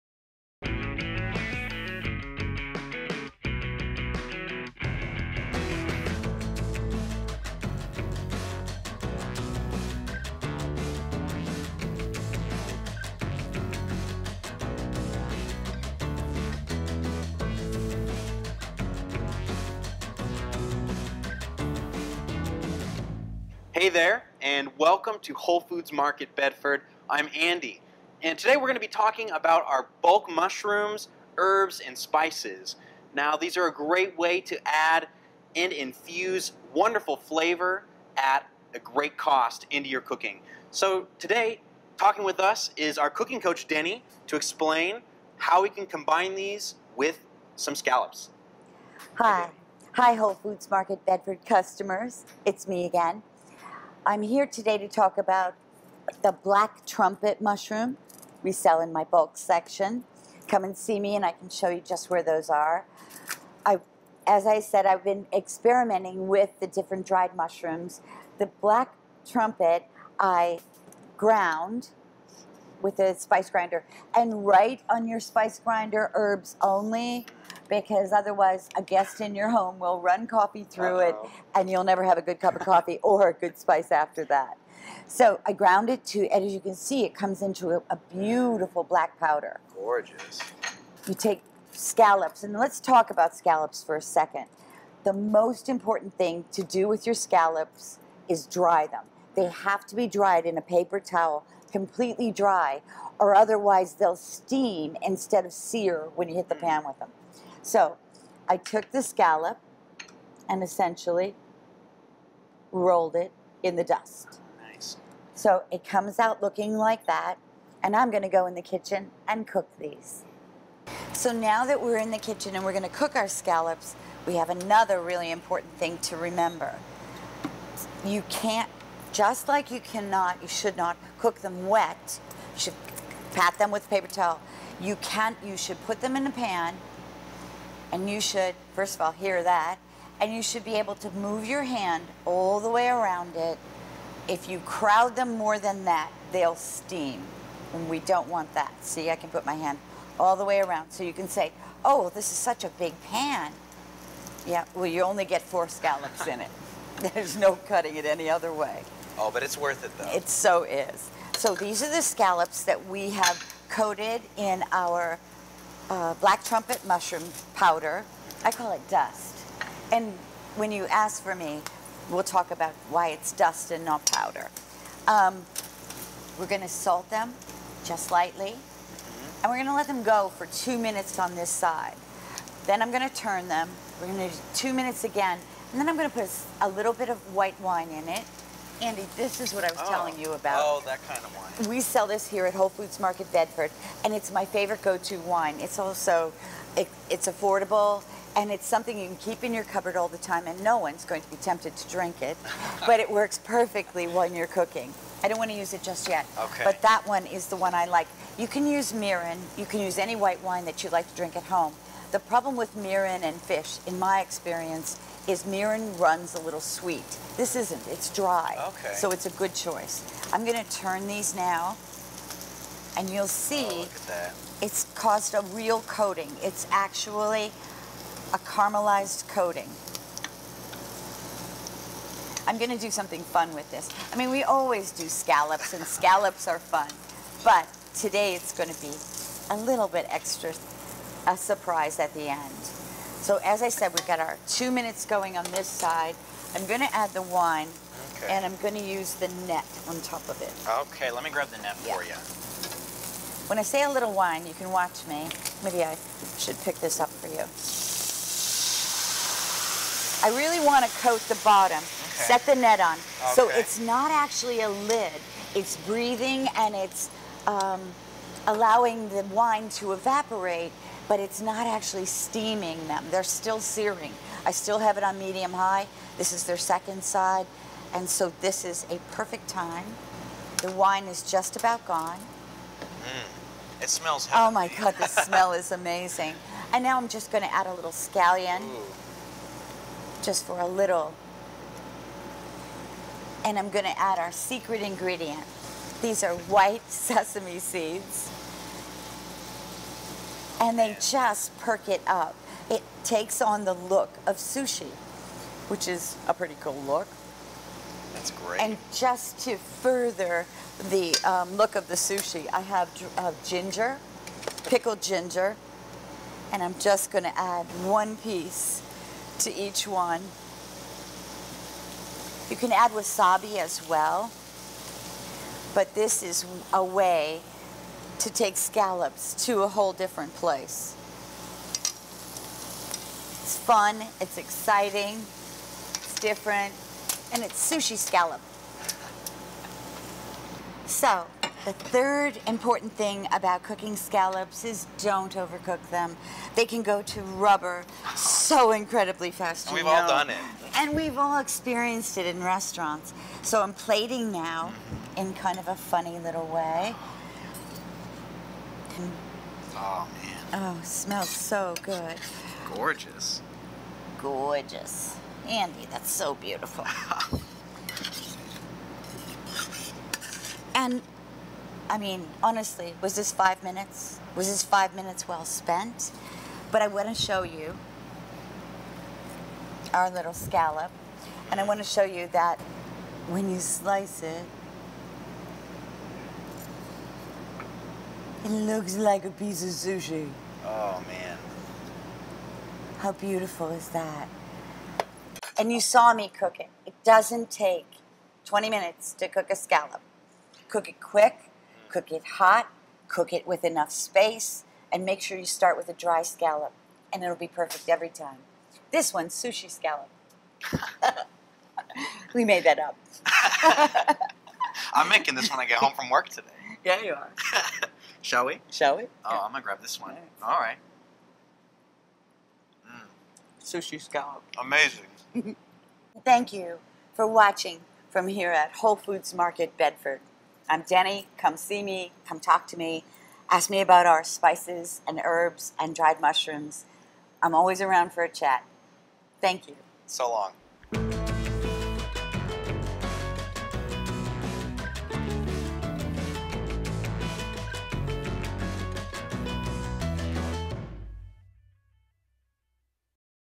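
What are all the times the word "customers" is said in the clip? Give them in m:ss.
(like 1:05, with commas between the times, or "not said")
0:51.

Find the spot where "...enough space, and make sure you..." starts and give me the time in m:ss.
6:43.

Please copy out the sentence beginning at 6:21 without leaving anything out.
And I want to show you that when you slice it, It looks like a piece of sushi.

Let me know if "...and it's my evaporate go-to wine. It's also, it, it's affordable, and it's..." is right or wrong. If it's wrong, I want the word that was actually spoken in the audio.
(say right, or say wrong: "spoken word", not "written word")
wrong: "favorite", not "evaporate".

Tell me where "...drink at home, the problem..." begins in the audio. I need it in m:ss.
3:31.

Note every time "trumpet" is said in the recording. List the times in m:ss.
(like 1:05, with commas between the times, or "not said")
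0:56, 1:09, 2:46.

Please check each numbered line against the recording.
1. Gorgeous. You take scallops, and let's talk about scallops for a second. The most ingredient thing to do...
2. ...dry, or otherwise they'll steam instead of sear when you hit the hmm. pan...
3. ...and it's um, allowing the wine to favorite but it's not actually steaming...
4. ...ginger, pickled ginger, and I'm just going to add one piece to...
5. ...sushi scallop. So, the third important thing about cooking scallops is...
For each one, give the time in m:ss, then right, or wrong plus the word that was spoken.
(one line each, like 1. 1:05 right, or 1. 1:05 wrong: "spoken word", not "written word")
1. 1:29 wrong: "important", not "ingredient"
2. 1:42 right
3. 4:26 wrong: "evaporate", not "favorite"
4. 5:13 right
5. 5:37 right.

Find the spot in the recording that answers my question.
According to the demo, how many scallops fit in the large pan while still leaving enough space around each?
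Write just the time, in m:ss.
2:35.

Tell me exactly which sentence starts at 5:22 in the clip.
You can add wasabi as well, but this is a way to take scallops to a whole different place.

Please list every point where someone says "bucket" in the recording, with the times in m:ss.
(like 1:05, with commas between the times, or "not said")
not said.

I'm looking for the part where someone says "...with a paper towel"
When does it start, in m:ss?
2:13.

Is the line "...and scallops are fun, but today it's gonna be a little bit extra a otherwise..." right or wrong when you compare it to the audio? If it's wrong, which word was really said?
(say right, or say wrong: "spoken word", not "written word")
wrong: "surprise", not "otherwise".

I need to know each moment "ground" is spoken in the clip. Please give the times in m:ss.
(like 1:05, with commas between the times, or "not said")
1:11, 1:25.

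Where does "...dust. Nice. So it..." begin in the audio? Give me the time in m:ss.
1:53.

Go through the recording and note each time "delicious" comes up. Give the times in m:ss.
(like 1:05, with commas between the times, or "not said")
not said.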